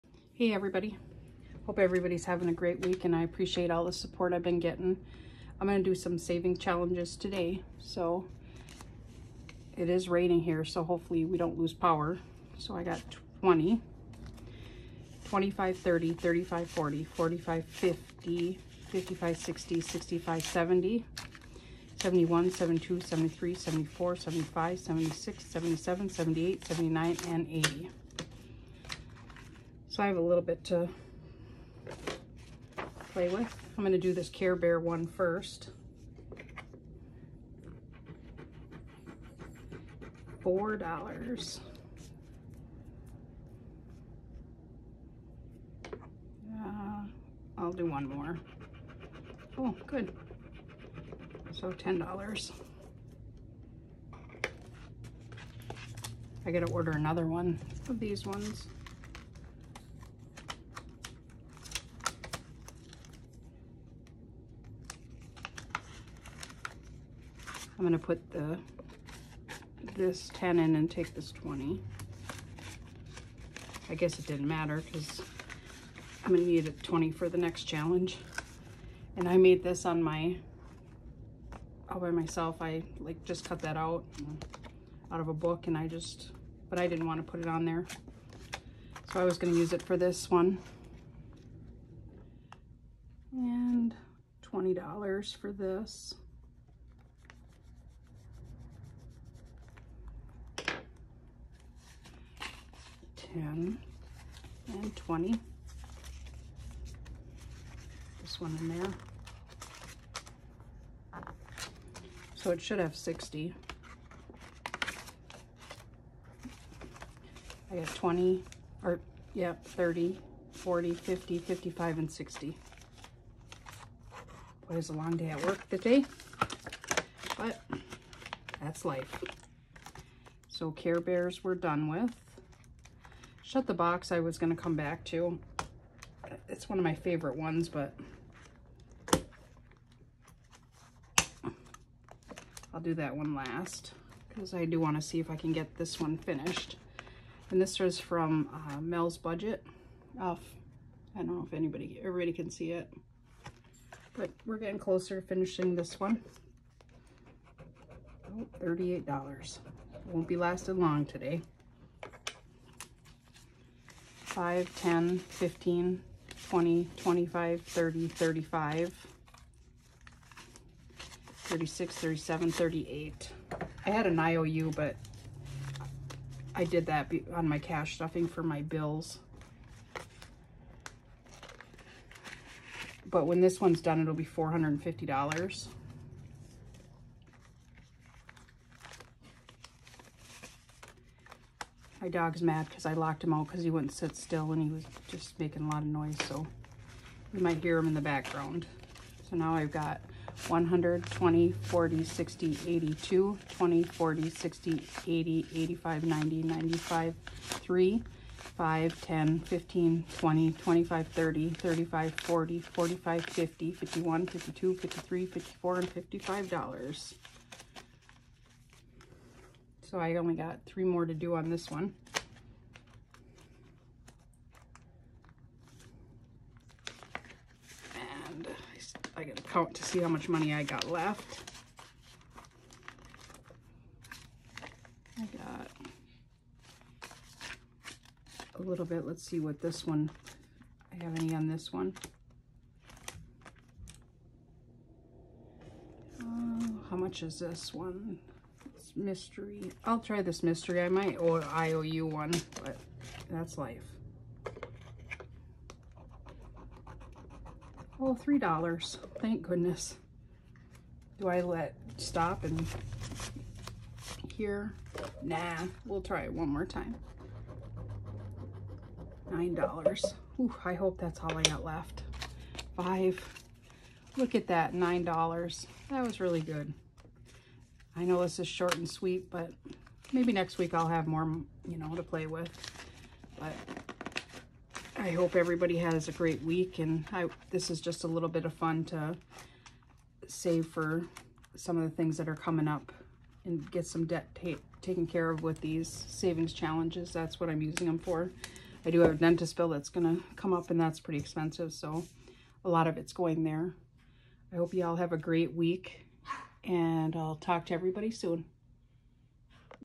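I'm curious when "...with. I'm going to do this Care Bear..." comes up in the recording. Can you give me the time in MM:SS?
00:33.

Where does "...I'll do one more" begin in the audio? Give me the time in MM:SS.
00:47.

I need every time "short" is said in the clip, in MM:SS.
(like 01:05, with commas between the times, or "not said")
04:38.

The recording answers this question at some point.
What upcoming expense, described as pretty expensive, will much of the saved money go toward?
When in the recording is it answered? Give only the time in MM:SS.
04:59.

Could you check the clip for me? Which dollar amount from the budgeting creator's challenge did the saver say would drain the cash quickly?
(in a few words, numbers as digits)
$38.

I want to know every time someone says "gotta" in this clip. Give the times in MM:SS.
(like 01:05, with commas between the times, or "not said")
00:56, 03:49.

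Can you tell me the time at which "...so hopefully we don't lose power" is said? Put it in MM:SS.
00:10.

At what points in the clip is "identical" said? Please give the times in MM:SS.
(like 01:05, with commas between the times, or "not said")
not said.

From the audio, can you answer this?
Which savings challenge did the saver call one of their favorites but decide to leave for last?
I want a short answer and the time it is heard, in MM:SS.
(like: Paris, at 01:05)
Shut the Box, at 02:13.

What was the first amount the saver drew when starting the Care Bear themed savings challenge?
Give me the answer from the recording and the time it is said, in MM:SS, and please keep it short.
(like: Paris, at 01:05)
$4, at 00:40.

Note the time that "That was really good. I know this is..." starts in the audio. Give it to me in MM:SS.
04:35.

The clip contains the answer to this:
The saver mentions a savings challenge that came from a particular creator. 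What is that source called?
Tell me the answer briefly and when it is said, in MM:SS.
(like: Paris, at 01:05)
Mel's Budget, at 02:28.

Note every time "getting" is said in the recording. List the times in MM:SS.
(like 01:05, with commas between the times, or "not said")
00:04, 02:34.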